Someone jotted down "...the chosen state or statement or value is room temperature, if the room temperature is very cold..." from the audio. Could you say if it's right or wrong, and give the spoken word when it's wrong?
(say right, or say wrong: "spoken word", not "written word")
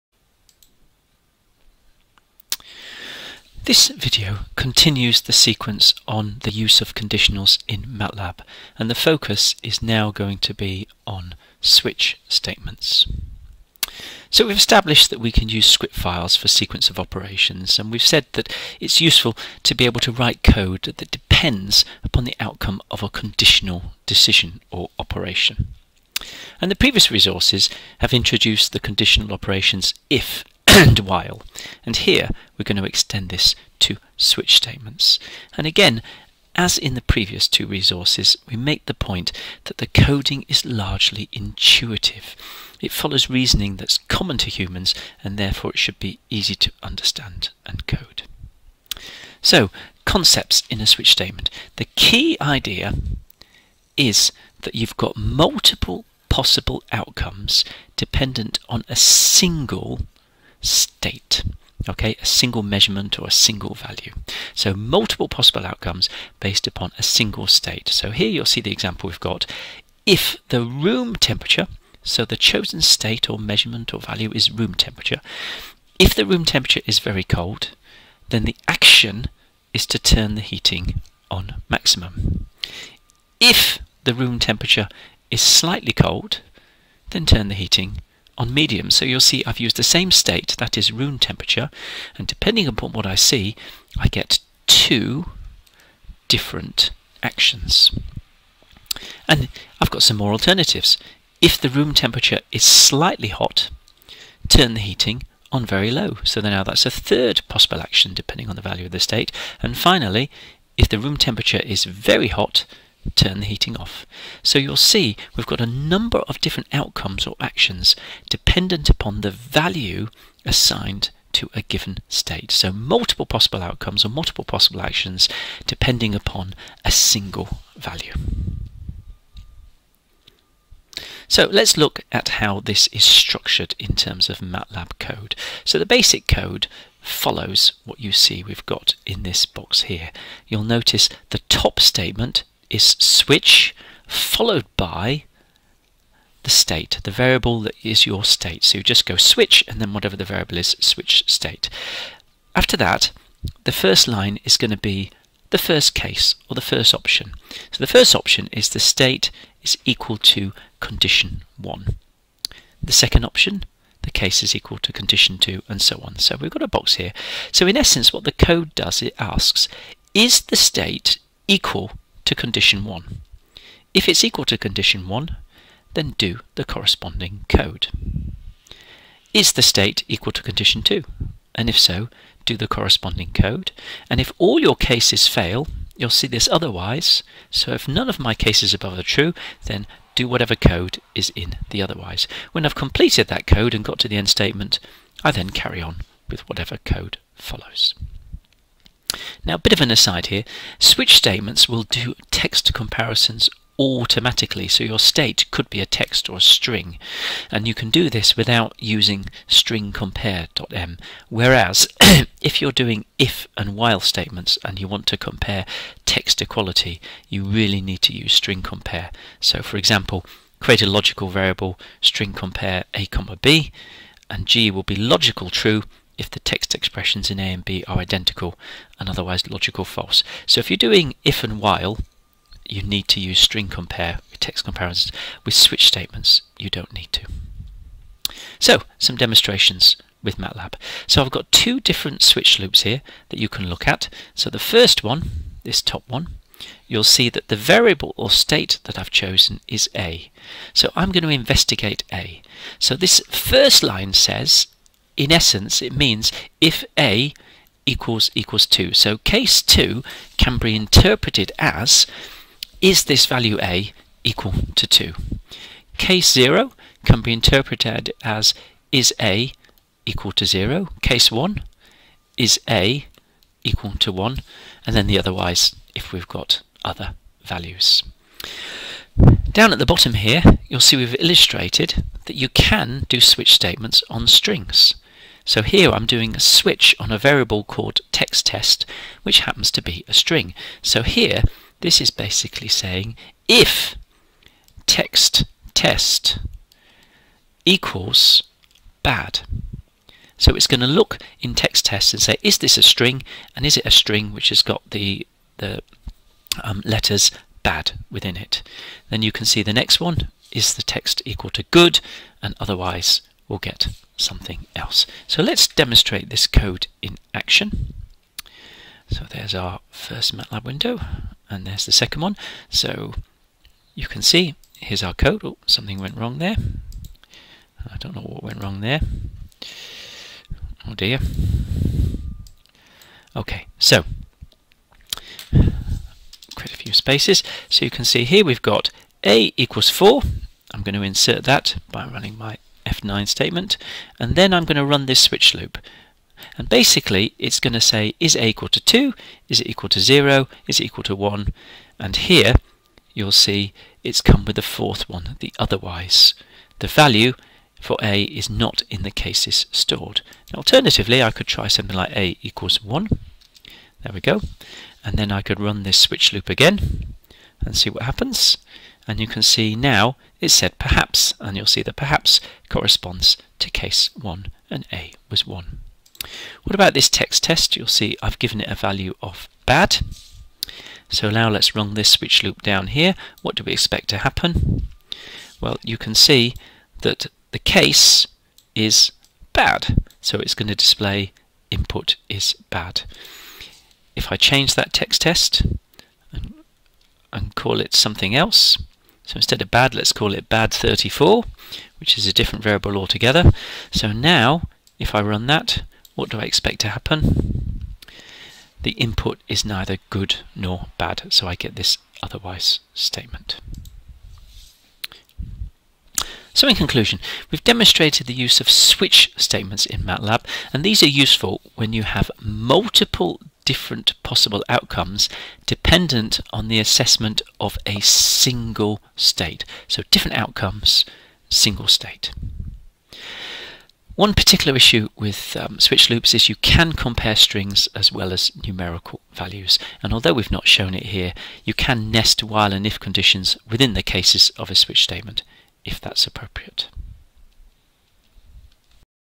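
wrong: "measurement", not "statement".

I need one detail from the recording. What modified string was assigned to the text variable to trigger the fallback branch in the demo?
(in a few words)
bad34.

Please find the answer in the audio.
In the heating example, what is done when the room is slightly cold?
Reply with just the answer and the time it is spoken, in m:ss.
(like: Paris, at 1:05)
Turn the heating on medium, at 1:27.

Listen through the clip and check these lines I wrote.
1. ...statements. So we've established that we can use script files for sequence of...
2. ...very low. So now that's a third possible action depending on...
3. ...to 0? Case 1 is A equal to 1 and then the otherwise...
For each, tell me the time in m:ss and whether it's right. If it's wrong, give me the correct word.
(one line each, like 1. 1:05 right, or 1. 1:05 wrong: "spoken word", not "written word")
1. 0:12 right
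2. 1:45 right
3. 4:30 right.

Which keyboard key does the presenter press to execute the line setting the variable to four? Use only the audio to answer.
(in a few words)
F9.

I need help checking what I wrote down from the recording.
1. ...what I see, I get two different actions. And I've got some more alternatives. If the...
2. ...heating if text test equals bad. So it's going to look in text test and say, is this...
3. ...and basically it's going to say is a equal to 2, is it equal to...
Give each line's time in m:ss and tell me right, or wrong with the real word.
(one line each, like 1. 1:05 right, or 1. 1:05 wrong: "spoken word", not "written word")
1. 1:32 right
2. 4:52 wrong: "saying", not "heating"
3. 5:46 right.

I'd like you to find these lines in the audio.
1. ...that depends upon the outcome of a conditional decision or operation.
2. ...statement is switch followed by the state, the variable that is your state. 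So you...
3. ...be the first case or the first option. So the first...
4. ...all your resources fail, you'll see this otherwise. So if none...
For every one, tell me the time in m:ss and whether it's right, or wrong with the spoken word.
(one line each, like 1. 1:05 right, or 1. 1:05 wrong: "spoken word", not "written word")
1. 0:20 right
2. 2:21 right
3. 2:34 right
4. 3:04 wrong: "cases", not "resources".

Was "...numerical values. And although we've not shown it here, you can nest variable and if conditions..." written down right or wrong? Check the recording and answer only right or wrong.
wrong.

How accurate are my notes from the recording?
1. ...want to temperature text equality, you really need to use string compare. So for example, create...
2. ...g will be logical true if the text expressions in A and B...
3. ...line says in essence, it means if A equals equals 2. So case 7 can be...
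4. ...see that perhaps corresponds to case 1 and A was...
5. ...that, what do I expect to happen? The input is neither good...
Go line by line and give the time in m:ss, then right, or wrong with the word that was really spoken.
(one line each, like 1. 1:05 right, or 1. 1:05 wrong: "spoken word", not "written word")
1. 3:34 wrong: "compare", not "temperature"
2. 3:44 right
3. 4:13 wrong: "2", not "7"
4. 6:11 right
5. 6:45 right.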